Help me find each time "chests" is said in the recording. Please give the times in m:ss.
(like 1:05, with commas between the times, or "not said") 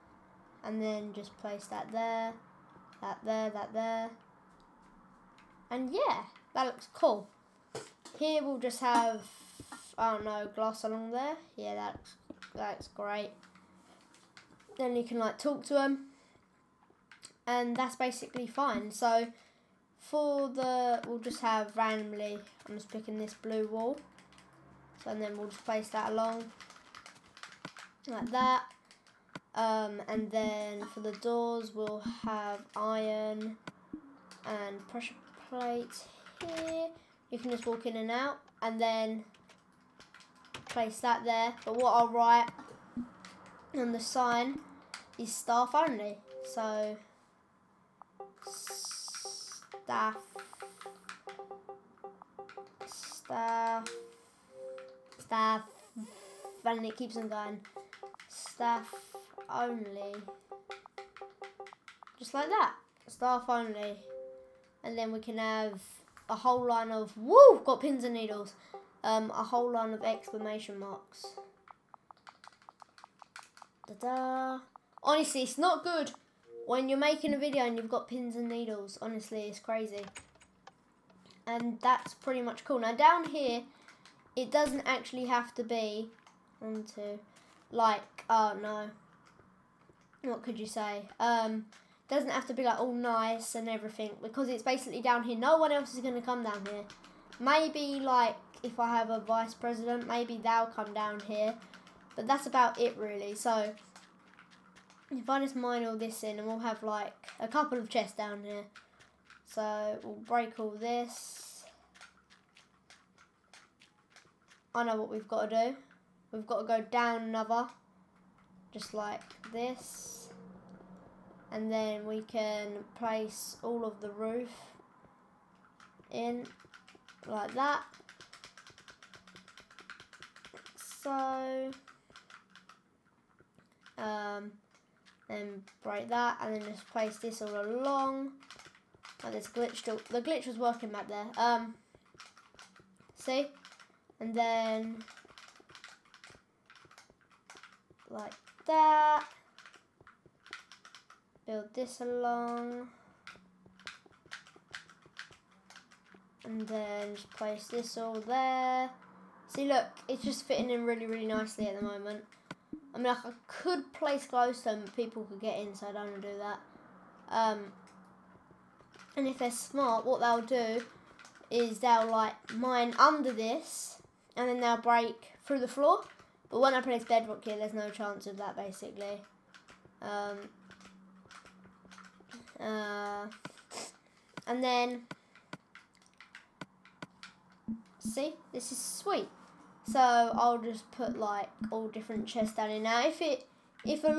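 1:47, 3:12.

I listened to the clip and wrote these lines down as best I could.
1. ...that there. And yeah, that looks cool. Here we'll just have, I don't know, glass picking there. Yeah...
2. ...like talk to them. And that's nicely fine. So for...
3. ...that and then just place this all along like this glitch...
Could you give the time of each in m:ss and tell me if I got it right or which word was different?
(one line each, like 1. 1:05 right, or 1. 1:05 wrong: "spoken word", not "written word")
1. 0:03 wrong: "along", not "picking"
2. 0:15 wrong: "basically", not "nicely"
3. 2:16 right.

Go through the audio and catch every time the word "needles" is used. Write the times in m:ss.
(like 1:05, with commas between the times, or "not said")
1:08, 1:18.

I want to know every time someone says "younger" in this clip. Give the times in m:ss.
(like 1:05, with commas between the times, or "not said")
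not said.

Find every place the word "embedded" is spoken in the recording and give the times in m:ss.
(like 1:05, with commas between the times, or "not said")
not said.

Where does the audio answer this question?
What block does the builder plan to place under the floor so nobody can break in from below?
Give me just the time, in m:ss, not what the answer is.
2:57.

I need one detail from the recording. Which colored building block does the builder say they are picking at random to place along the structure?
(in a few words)
Blue wool.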